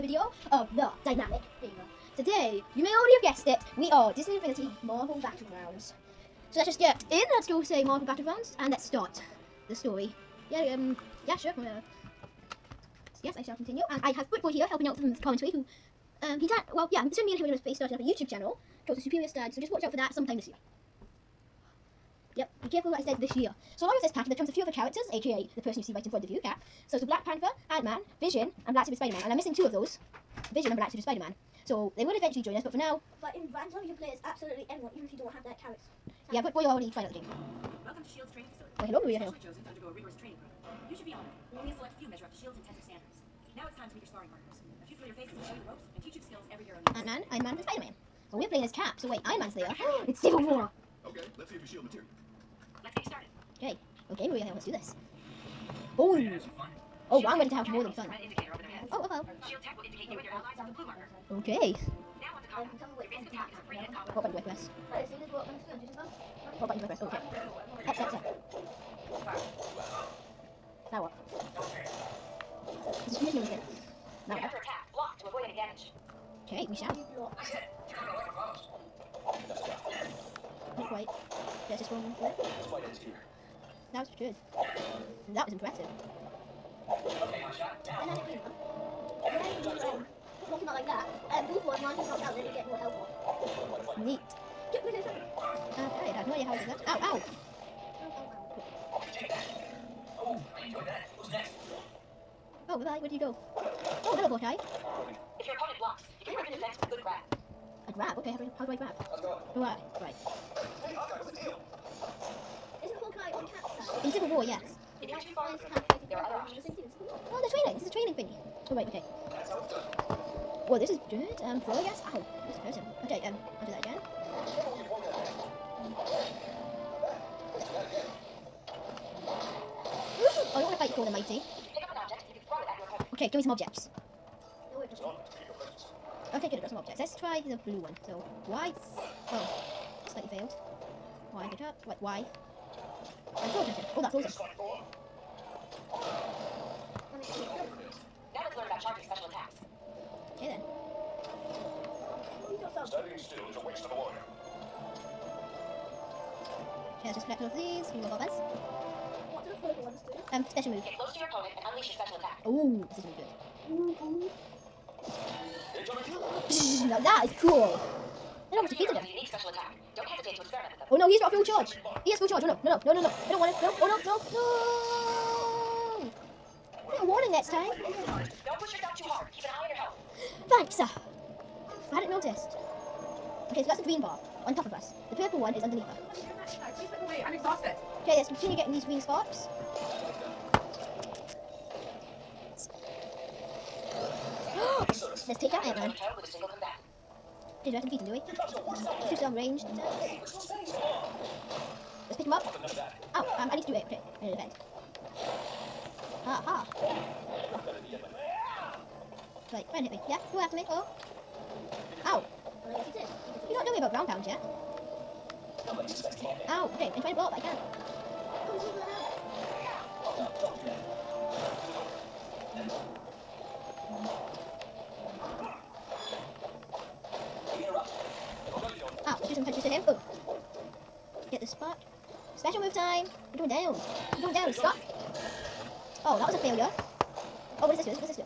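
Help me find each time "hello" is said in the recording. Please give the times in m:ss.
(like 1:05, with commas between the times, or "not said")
0:38, 1:44.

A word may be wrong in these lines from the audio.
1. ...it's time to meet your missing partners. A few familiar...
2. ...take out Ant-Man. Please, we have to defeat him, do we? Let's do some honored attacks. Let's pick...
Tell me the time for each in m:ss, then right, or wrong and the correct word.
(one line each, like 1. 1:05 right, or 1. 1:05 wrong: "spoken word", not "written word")
1. 0:43 wrong: "sparring", not "missing"
2. 3:15 wrong: "ranged", not "honored".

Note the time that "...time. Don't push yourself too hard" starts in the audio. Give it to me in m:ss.
2:57.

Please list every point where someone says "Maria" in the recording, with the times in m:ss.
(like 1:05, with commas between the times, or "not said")
0:39, 0:54.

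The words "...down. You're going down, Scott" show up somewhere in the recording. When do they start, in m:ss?
3:53.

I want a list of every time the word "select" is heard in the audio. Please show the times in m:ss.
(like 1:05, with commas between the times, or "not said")
0:41.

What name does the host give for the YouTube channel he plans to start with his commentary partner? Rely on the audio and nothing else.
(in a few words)
Superior Stud.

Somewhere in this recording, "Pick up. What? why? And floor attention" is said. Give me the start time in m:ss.
2:21.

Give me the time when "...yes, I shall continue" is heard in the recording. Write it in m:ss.
0:13.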